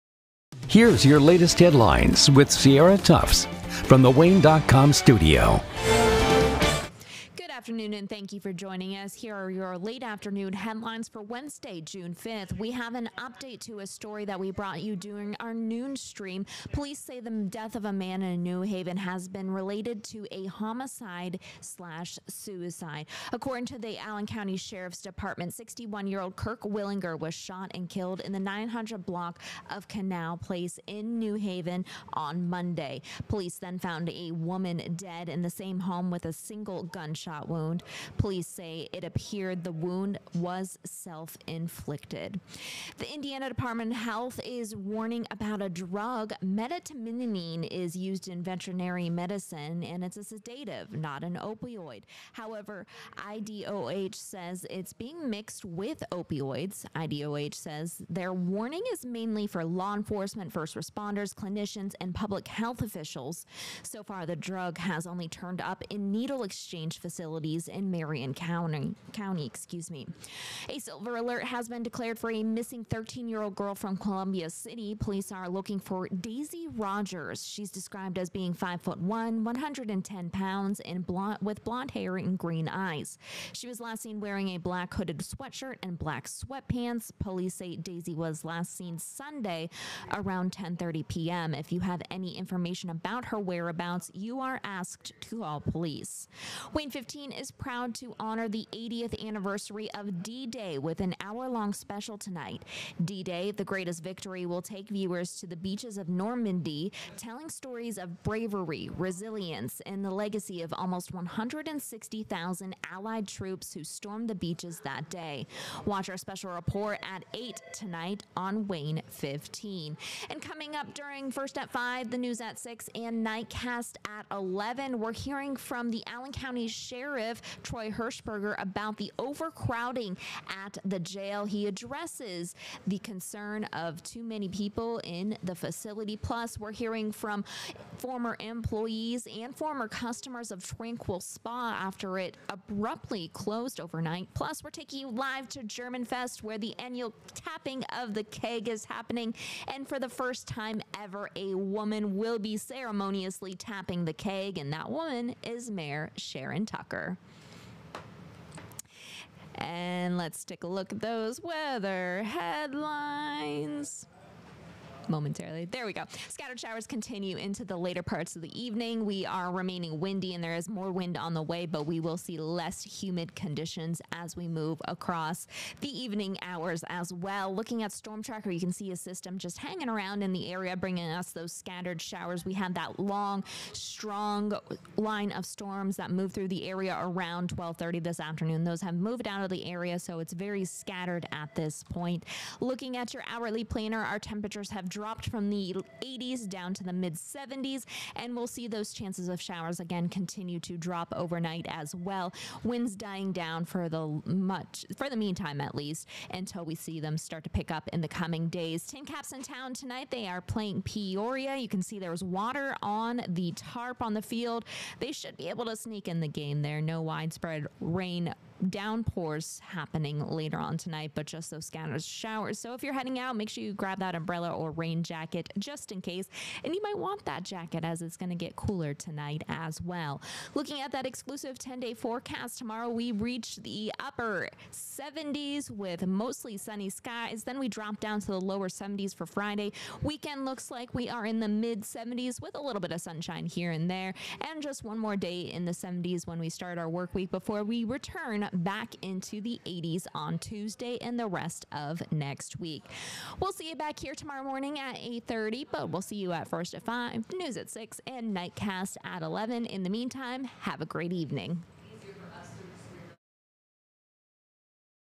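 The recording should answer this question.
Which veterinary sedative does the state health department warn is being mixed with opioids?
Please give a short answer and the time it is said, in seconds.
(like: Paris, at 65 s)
Medetomidine, at 46 s.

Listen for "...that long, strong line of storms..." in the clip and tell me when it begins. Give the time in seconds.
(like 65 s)
182 s.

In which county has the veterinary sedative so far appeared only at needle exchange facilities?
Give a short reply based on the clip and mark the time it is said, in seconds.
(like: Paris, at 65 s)
Marion County, at 67 s.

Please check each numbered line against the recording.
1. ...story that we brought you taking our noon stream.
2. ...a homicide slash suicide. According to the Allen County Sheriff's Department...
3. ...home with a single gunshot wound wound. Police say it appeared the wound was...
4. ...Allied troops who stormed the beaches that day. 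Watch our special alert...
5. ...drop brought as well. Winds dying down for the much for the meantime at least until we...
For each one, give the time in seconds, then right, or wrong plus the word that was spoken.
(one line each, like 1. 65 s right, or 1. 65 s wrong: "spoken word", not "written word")
1. 13 s wrong: "during", not "taking"
2. 20 s right
3. 35 s right
4. 112 s wrong: "report", not "alert"
5. 200 s wrong: "overnight", not "brought".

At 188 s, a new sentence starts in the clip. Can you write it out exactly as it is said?
Those have moved out of the area, so it's very scattered at this point.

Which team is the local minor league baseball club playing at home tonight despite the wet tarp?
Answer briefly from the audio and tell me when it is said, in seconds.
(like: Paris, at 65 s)
Peoria, at 210 s.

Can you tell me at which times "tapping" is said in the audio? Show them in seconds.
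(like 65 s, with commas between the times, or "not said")
147 s, 153 s.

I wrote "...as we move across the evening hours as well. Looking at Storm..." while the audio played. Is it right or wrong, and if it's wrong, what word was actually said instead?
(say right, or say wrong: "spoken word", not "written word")
right.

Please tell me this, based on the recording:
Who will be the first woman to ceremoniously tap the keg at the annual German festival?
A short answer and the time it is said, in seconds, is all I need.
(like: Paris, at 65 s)
Sharon Tucker, at 156 s.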